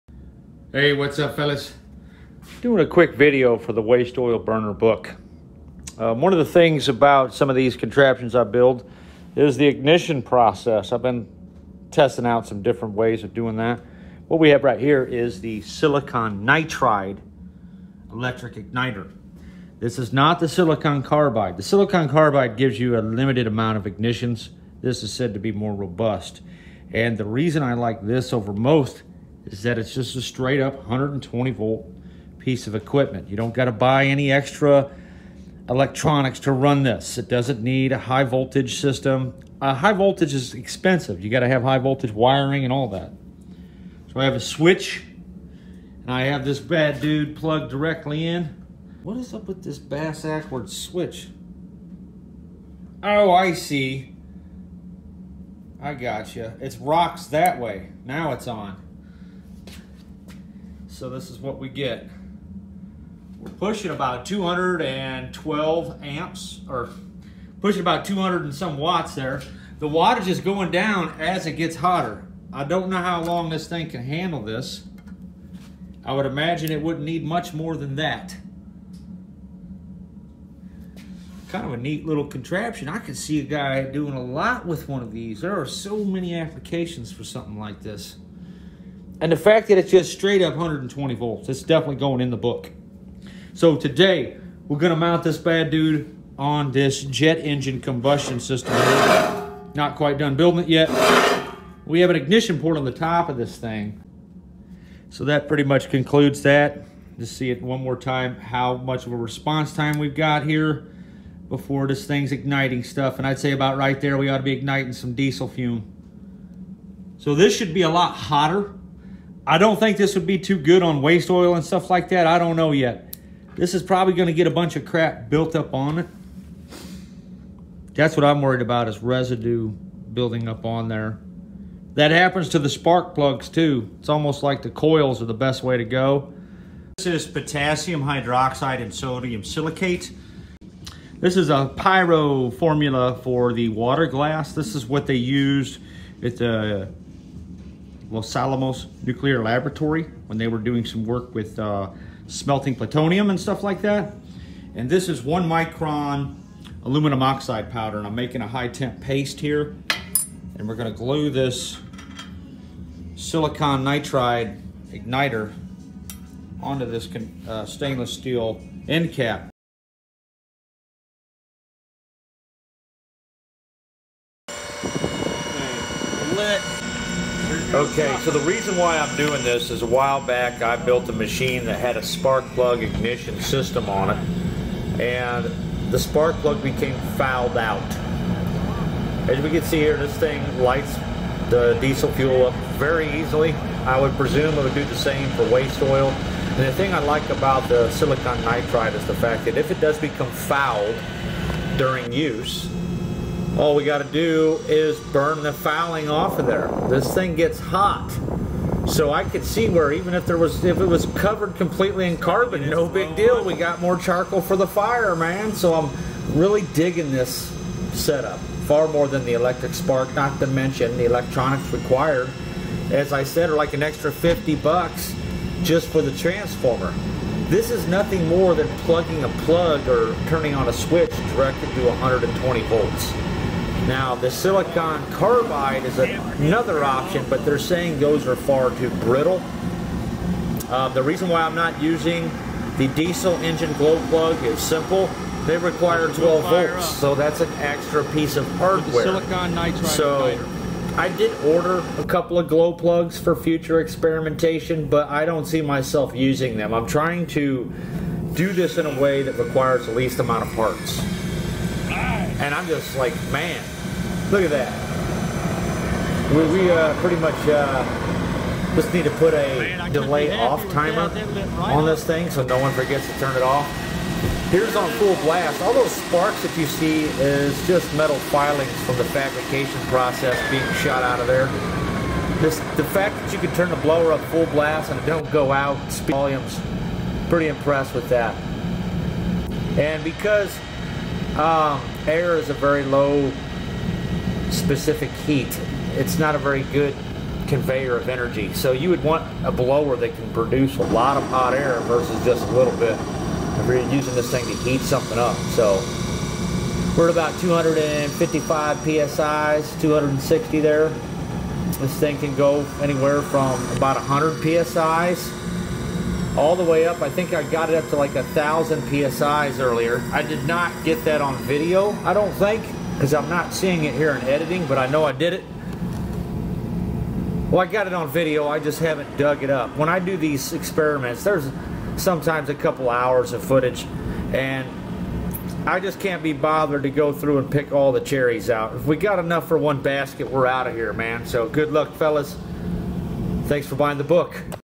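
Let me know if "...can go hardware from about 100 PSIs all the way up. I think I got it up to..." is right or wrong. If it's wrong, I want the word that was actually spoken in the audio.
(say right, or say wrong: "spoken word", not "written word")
wrong: "anywhere", not "hardware".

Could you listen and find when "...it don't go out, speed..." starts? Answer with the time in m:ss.
4:45.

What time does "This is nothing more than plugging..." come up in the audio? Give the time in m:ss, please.
3:47.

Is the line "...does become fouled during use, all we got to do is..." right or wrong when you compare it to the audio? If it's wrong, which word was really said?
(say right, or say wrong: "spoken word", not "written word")
right.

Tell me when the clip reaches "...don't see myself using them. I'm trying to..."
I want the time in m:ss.
4:15.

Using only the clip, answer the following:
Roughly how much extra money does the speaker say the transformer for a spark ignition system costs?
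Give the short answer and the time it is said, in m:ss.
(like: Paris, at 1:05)
50 bucks, at 3:44.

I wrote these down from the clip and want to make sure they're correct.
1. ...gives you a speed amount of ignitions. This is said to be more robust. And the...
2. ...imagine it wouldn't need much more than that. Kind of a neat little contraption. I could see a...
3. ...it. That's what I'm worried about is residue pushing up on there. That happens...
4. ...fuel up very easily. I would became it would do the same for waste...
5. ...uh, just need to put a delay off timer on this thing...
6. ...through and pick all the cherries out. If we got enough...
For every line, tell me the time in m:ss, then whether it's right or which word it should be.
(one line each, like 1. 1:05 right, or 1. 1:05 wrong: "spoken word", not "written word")
1. 0:22 wrong: "limited", not "speed"
2. 1:16 right
3. 2:05 wrong: "building", not "pushing"
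4. 3:12 wrong: "presume", not "became"
5. 4:27 right
6. 5:37 right.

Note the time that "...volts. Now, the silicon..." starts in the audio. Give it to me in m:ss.
3:52.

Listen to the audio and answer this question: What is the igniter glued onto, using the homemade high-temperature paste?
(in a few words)
stainless steel end cap.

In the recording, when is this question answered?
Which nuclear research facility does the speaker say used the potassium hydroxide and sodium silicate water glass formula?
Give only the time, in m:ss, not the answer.
2:28.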